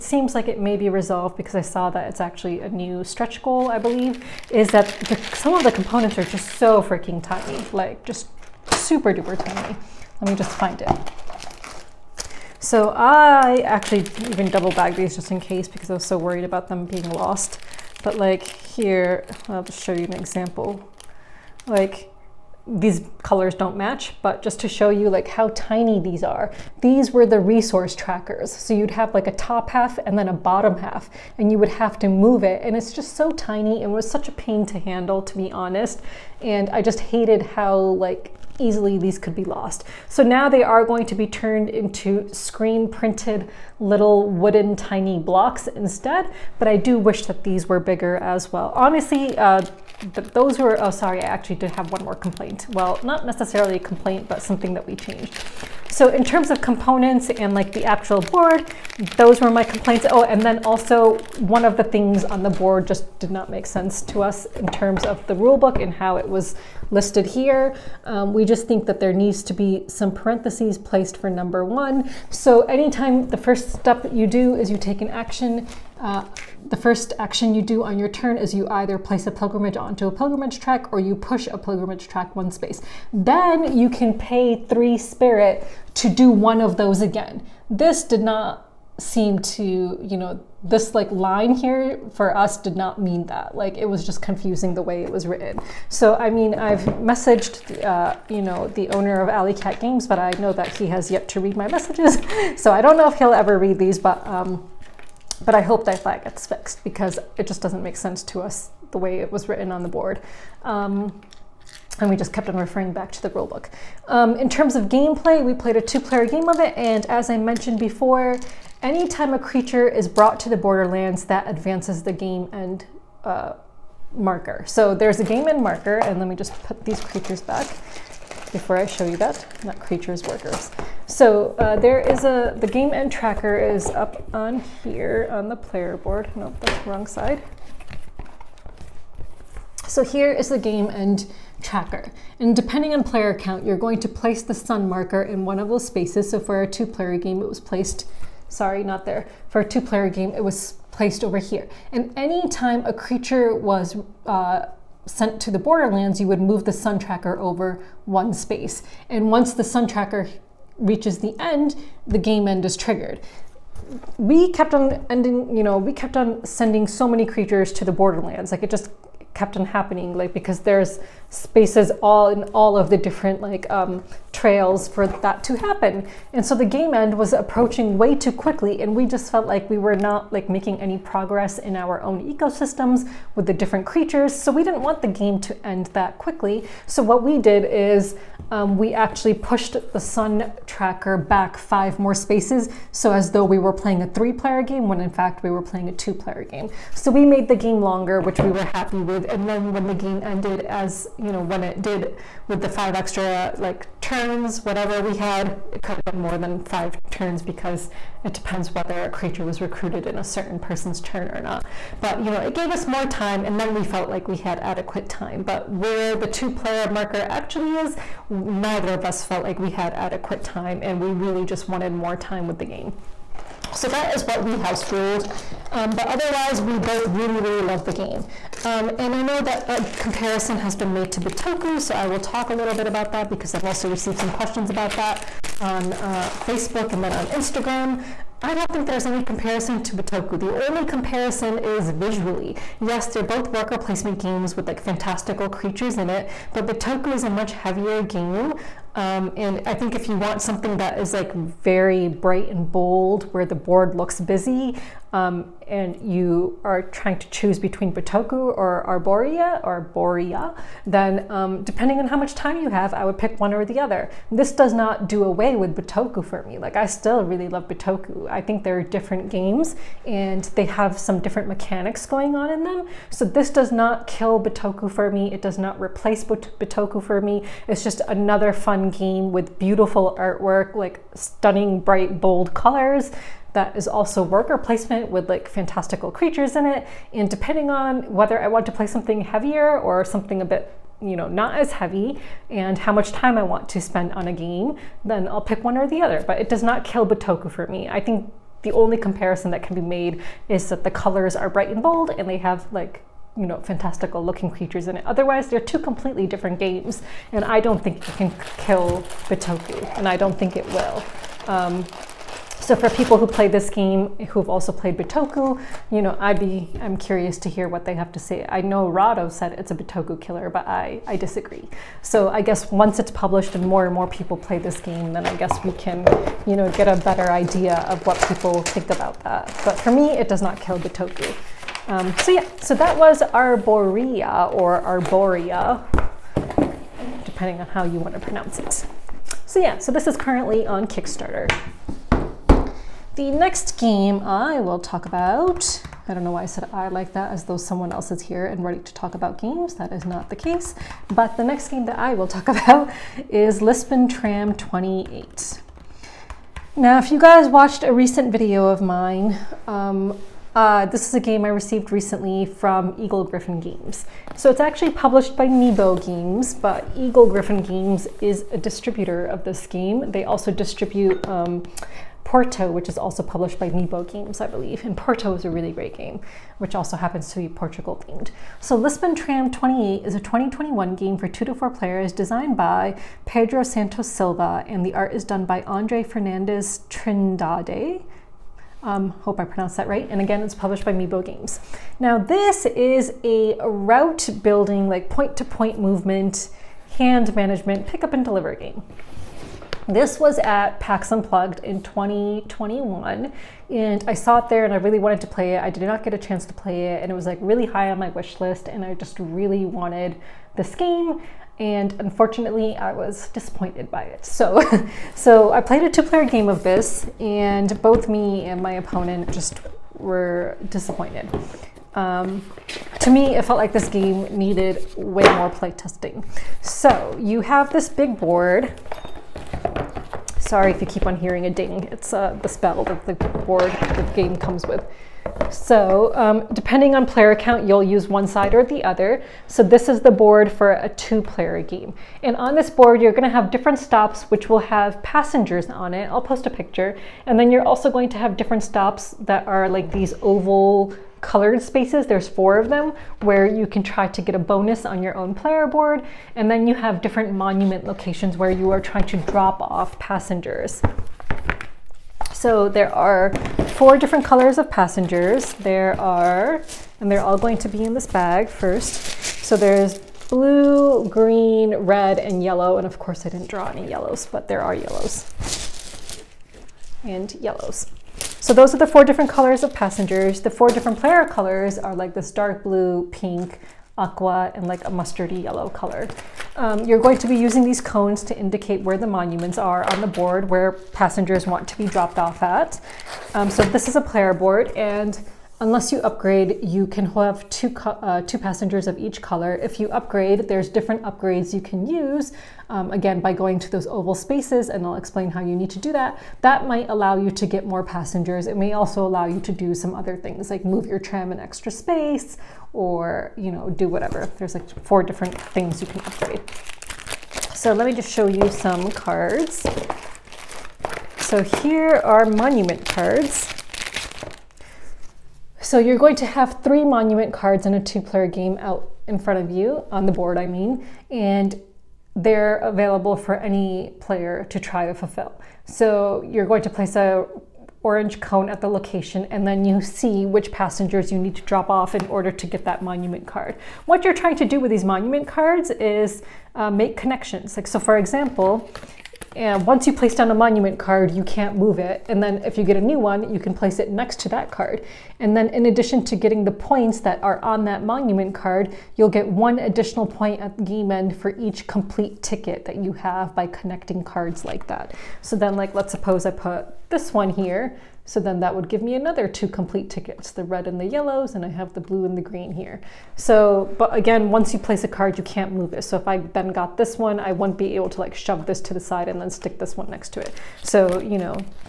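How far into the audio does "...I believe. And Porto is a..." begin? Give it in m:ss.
6:14.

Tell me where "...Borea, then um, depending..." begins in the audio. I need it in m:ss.
4:19.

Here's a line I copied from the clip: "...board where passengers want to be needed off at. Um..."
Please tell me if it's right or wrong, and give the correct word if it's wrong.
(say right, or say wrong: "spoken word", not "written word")
wrong: "dropped", not "needed".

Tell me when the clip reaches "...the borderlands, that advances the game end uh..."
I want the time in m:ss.
2:00.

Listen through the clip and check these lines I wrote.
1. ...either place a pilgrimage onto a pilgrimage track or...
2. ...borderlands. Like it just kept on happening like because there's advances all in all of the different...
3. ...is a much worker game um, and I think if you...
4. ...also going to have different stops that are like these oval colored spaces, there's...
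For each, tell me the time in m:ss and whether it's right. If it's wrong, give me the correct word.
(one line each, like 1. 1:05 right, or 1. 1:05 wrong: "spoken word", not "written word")
1. 1:18 right
2. 2:47 wrong: "spaces", not "advances"
3. 4:07 wrong: "heavier", not "worker"
4. 7:27 right.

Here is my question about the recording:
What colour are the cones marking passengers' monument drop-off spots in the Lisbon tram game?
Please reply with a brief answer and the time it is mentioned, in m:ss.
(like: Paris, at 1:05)
orange, at 8:57.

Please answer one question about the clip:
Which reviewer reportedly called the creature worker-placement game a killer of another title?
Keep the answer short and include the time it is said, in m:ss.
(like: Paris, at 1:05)
Rahdo, at 5:18.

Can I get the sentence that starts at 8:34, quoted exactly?
There's like four different things you can upgrade.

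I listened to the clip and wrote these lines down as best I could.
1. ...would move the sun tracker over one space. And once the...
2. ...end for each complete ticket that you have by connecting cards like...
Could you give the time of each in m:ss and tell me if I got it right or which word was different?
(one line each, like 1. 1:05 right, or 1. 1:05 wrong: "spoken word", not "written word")
1. 2:36 right
2. 9:20 right.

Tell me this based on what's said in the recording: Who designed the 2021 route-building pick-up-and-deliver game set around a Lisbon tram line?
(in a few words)
Pedro Santos Silva.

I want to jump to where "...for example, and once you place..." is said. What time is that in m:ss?
9:07.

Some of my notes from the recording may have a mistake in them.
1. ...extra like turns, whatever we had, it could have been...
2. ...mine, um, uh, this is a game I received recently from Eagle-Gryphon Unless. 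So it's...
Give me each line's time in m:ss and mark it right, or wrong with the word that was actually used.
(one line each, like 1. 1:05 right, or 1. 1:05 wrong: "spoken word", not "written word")
1. 3:22 right
2. 5:58 wrong: "Games", not "Unless".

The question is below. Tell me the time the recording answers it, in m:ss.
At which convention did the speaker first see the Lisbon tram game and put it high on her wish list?
6:40.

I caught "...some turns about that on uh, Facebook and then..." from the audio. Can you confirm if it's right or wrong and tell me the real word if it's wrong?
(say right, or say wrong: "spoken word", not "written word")
wrong: "questions", not "turns".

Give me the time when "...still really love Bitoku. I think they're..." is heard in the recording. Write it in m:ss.
4:26.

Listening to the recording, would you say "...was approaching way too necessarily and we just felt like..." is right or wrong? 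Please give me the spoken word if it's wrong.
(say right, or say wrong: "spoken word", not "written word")
wrong: "quickly", not "necessarily".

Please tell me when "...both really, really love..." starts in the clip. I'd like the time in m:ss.
3:46.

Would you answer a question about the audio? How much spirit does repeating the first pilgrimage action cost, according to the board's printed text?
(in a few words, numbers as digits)
3.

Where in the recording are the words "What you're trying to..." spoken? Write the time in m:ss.
9:03.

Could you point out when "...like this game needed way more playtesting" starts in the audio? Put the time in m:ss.
7:03.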